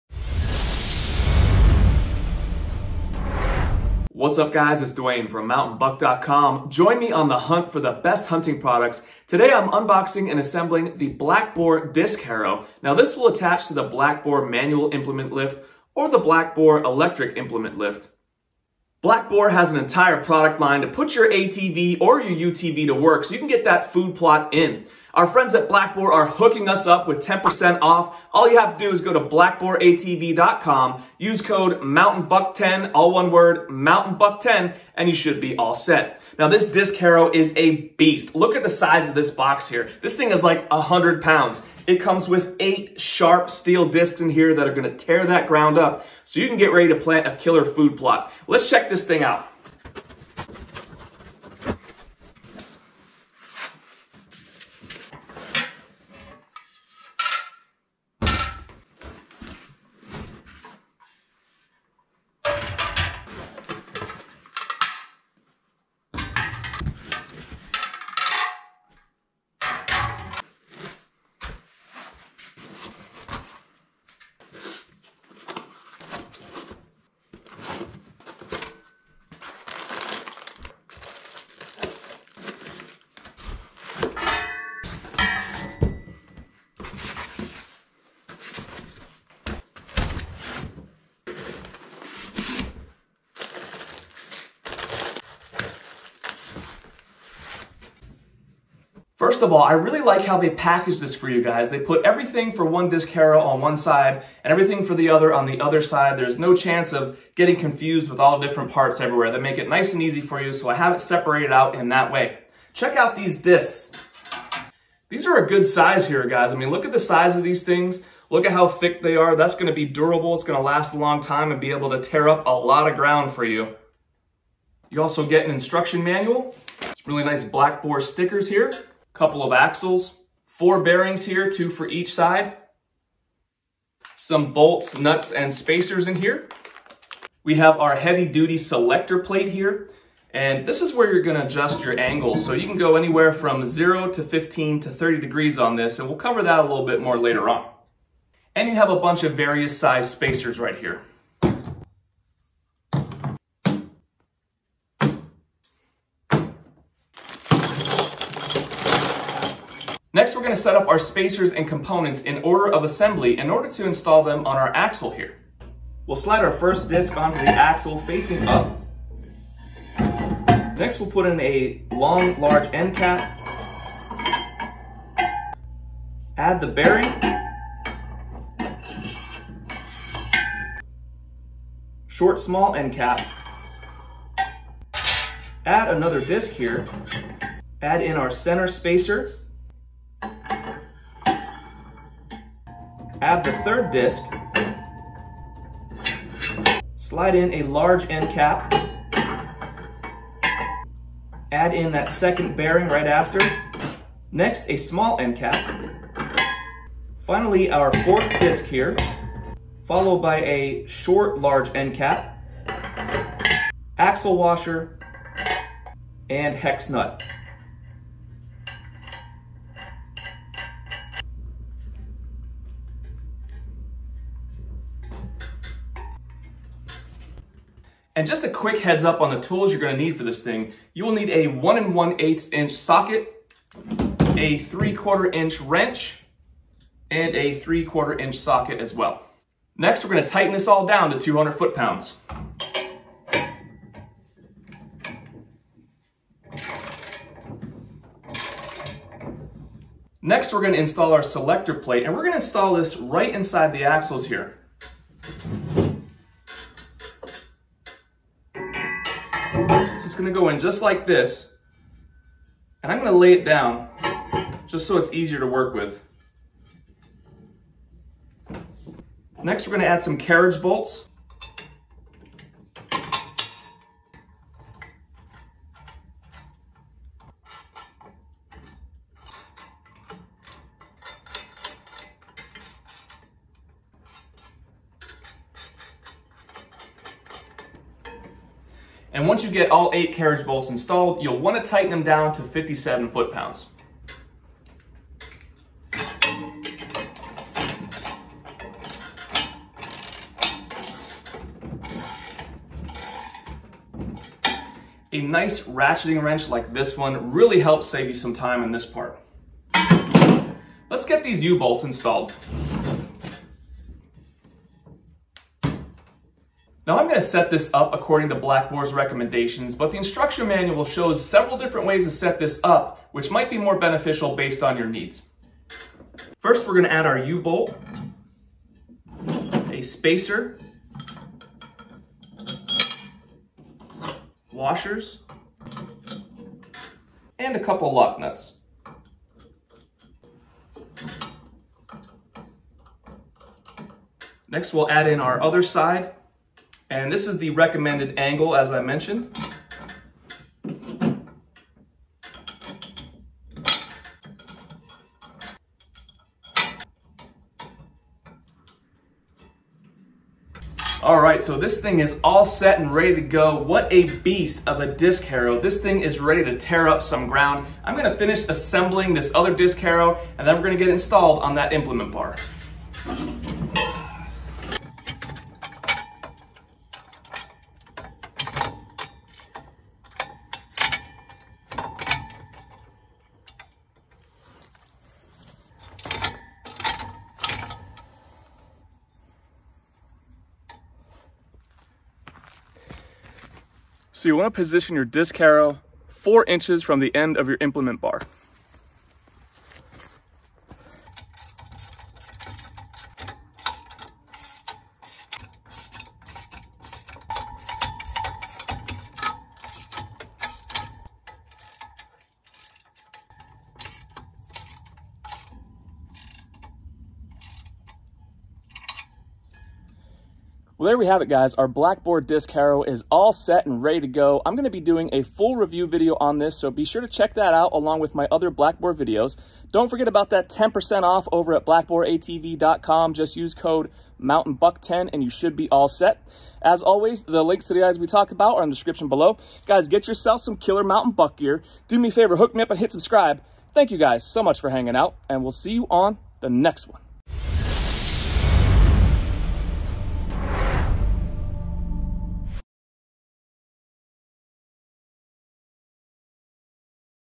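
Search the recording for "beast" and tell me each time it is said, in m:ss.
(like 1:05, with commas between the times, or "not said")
0:37, 6:04.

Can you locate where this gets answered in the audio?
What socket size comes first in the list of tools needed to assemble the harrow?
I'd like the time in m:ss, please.
3:51.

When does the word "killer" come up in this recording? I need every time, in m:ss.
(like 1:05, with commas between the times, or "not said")
0:47, 7:20.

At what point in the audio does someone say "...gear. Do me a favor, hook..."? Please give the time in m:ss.
7:21.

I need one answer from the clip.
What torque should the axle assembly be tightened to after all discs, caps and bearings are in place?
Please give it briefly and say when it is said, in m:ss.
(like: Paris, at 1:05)
200 foot pounds, at 4:01.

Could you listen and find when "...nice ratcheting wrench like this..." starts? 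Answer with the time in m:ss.
5:05.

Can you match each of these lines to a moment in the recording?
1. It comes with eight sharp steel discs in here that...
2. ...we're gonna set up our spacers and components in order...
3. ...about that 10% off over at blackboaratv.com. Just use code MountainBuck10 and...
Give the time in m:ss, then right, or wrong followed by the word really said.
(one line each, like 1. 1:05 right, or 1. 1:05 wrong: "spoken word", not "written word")
1. 0:41 right
2. 2:40 right
3. 7:10 right.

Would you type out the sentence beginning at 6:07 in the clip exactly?
I'm gonna finish assembling this other disc harrow and then we're gonna get installed on that implement bar.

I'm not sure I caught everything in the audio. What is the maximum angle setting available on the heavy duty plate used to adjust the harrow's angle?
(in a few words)
30 degrees.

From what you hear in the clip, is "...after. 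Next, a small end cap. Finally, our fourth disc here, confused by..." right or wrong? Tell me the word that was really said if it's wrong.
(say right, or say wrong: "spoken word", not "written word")
wrong: "followed", not "confused".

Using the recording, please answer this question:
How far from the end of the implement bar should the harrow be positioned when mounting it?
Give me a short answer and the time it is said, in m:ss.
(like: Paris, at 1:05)
4 inches, at 6:36.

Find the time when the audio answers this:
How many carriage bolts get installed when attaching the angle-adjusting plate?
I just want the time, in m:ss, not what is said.
4:49.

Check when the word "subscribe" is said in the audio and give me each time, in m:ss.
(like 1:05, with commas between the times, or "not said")
7:22.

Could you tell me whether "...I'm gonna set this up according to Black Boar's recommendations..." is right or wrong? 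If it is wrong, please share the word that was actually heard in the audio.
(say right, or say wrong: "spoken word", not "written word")
right.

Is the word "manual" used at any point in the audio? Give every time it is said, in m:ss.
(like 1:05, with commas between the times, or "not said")
0:14, 2:06, 5:20.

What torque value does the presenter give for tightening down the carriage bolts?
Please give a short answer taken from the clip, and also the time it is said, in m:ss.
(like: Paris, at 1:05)
57 foot-pounds, at 4:52.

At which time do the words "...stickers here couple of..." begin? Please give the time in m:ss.
2:08.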